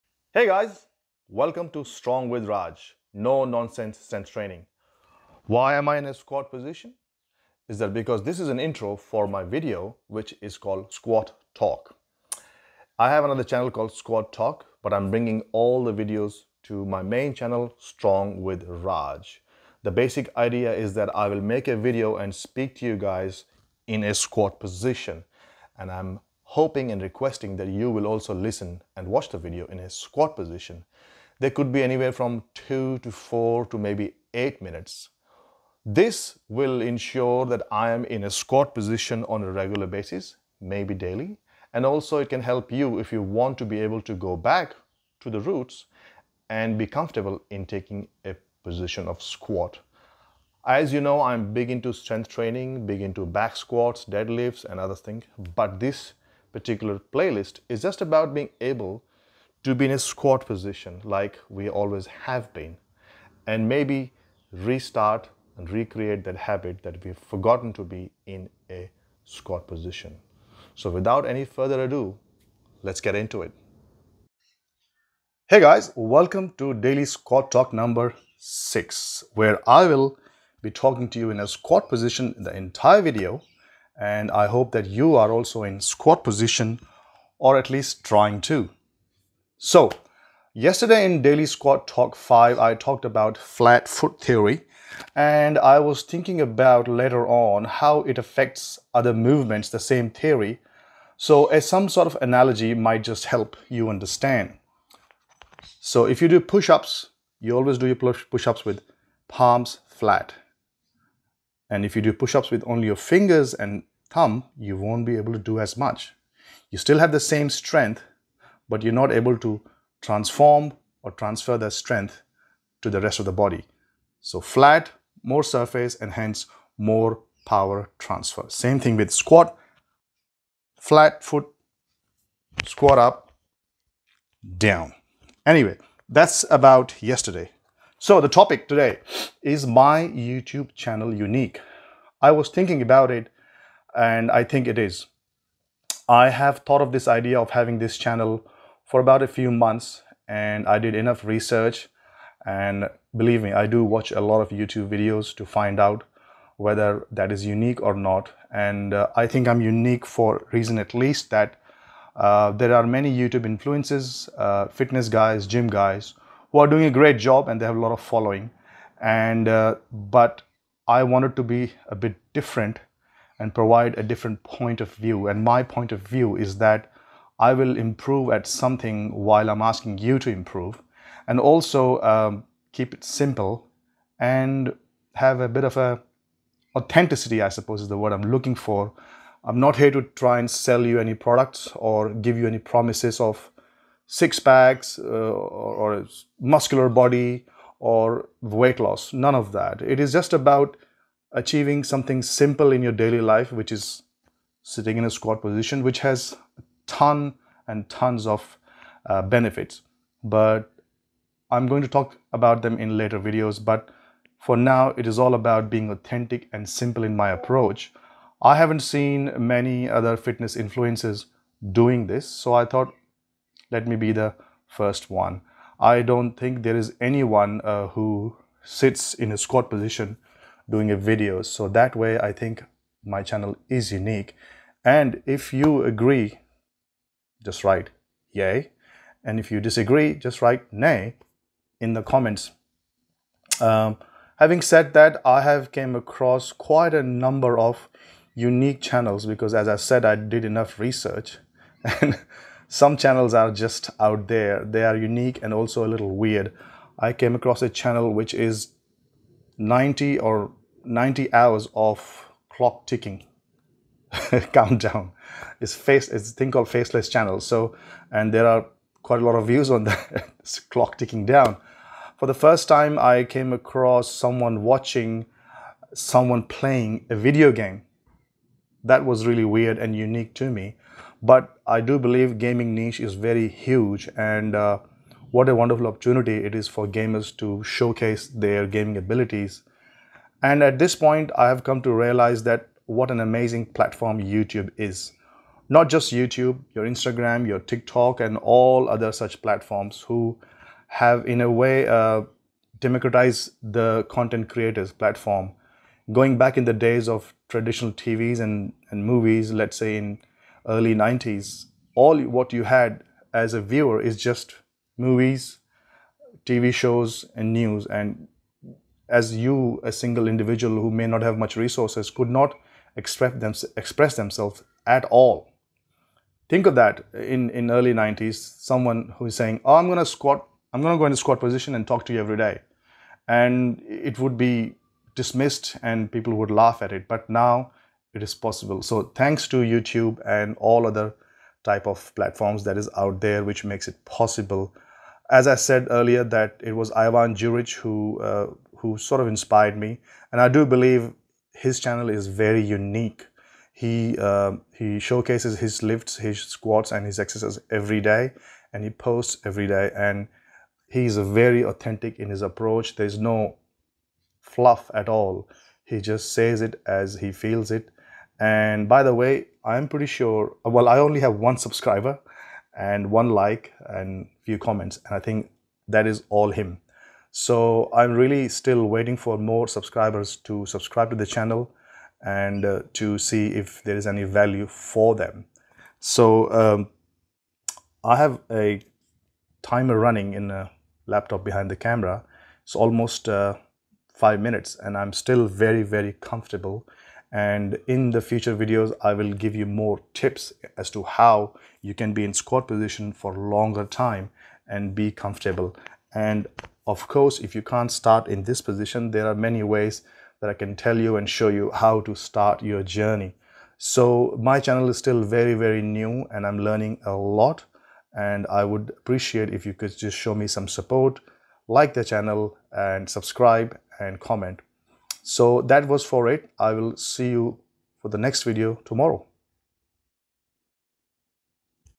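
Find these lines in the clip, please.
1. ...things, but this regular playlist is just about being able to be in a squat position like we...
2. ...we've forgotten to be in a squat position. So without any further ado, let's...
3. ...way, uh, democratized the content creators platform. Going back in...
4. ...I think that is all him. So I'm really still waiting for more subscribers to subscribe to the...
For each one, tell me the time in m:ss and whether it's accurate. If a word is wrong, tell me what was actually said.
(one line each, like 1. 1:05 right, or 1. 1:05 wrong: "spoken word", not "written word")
1. 0:54 wrong: "particular", not "regular"
2. 1:07 right
3. 5:01 right
4. 6:15 right.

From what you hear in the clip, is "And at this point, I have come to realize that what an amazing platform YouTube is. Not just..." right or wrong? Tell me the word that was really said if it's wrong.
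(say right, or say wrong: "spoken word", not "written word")
right.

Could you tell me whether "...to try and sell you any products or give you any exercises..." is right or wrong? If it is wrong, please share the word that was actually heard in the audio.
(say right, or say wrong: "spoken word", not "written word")
wrong: "promises", not "exercises".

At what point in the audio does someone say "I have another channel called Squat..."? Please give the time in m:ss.
0:12.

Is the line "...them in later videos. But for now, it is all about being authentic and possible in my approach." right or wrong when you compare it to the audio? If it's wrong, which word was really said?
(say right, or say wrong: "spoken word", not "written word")
wrong: "simple", not "possible".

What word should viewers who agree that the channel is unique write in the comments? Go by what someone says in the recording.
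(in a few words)
yay.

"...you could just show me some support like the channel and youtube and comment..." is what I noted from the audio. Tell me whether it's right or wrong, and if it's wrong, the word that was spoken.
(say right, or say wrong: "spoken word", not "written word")
wrong: "subscribe", not "youtube".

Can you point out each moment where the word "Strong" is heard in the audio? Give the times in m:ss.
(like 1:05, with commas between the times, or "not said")
0:01, 0:17.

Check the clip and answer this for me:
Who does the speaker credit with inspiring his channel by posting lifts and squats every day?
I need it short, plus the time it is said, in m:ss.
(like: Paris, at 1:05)
Ivan Juric, at 5:46.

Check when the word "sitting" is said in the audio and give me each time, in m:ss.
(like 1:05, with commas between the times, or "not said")
3:24.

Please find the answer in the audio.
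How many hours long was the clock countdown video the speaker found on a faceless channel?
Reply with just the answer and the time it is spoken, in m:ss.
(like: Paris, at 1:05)
90, at 4:20.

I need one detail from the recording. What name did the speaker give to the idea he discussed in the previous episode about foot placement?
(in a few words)
flat foot theory.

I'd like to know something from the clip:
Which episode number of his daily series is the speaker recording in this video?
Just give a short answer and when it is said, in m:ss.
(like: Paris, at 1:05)
6, at 1:16.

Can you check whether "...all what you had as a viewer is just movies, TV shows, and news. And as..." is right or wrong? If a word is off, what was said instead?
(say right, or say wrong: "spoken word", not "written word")
right.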